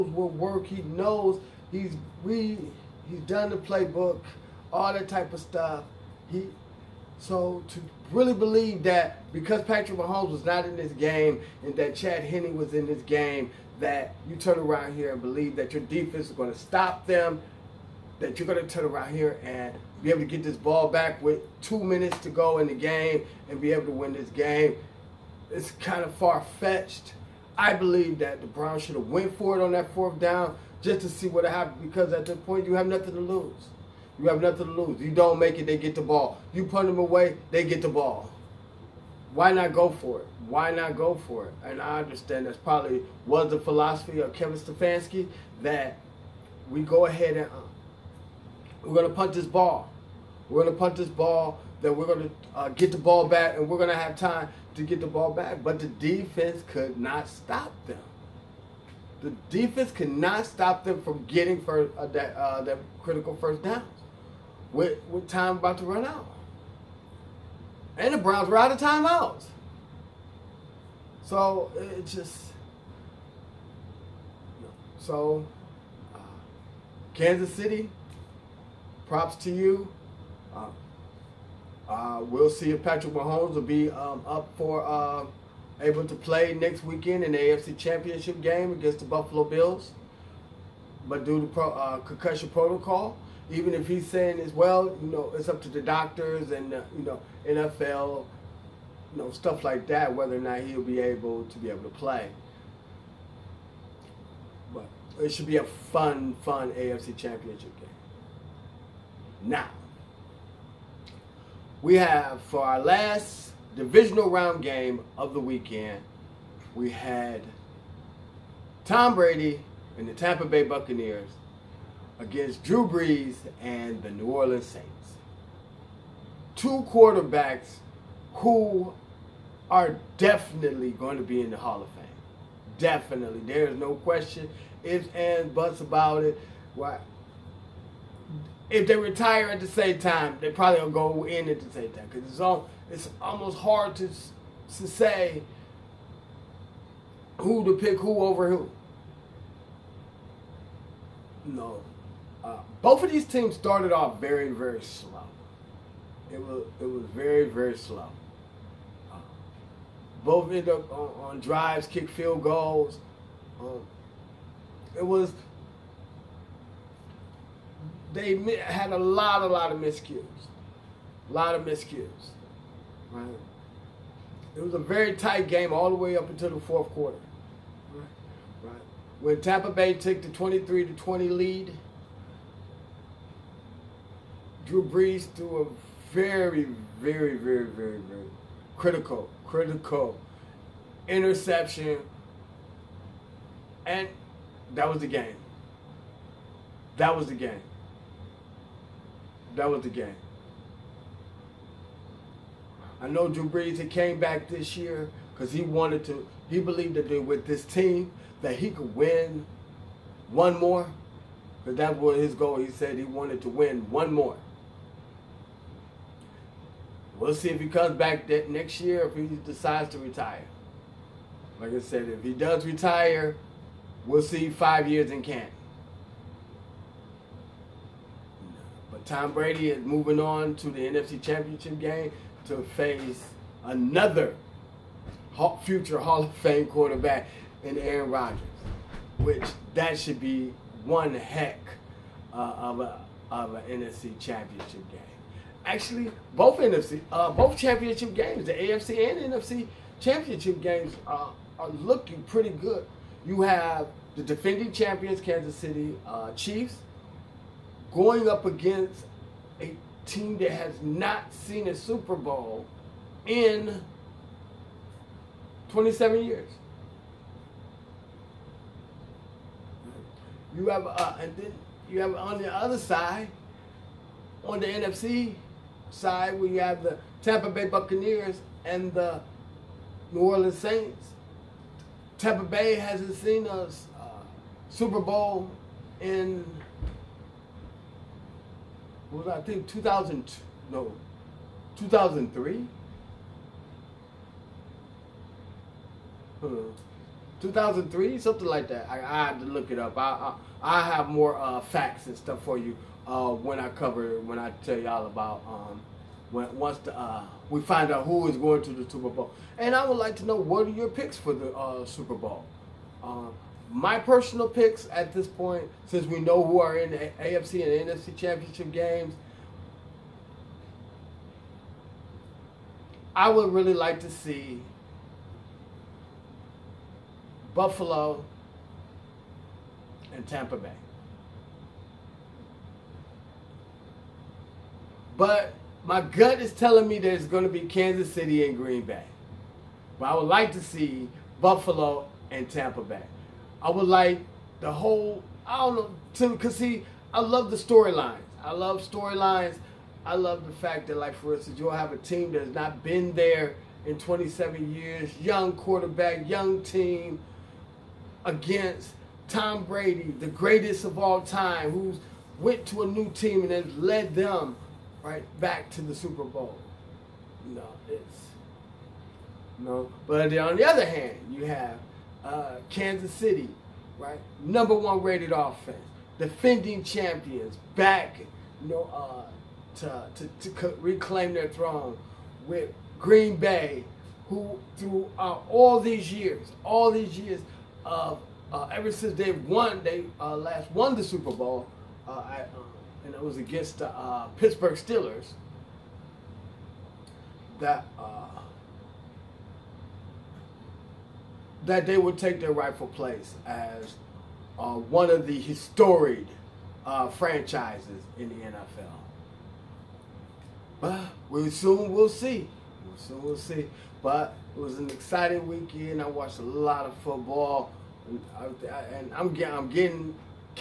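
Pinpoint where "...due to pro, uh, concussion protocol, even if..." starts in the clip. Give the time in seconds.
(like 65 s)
91 s.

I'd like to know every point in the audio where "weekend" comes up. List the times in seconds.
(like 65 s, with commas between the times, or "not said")
86 s, 115 s, 415 s.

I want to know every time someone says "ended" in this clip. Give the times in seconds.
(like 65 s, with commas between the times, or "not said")
160 s.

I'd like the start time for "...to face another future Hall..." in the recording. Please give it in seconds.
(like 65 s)
232 s.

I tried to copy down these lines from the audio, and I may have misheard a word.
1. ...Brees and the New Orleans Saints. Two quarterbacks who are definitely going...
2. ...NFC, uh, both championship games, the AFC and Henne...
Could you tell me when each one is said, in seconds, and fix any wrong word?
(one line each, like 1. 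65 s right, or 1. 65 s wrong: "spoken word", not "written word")
1. 122 s right
2. 246 s wrong: "NFC", not "Henne".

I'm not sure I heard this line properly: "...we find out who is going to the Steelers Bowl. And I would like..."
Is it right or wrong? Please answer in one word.
wrong.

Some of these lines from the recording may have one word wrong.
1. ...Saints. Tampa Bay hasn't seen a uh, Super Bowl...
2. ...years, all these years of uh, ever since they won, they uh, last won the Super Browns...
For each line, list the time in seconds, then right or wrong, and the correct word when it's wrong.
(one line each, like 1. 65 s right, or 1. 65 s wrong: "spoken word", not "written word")
1. 280 s right
2. 386 s wrong: "Bowl", not "Browns".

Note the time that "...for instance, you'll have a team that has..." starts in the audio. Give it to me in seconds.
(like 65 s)
351 s.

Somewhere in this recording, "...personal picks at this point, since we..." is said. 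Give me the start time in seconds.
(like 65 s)
313 s.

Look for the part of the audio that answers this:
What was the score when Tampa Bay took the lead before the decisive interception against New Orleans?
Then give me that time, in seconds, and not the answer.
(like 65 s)
180 s.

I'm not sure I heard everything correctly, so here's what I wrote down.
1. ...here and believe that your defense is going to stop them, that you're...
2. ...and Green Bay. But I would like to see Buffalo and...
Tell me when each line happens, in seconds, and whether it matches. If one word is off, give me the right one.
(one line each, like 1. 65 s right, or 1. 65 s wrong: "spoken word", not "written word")
1. 14 s right
2. 338 s right.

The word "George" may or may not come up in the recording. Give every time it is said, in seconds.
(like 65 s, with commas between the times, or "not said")
not said.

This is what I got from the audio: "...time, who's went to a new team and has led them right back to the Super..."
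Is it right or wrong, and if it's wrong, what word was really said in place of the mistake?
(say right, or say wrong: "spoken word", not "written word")
right.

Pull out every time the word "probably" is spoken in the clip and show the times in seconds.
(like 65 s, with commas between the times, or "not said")
42 s, 140 s.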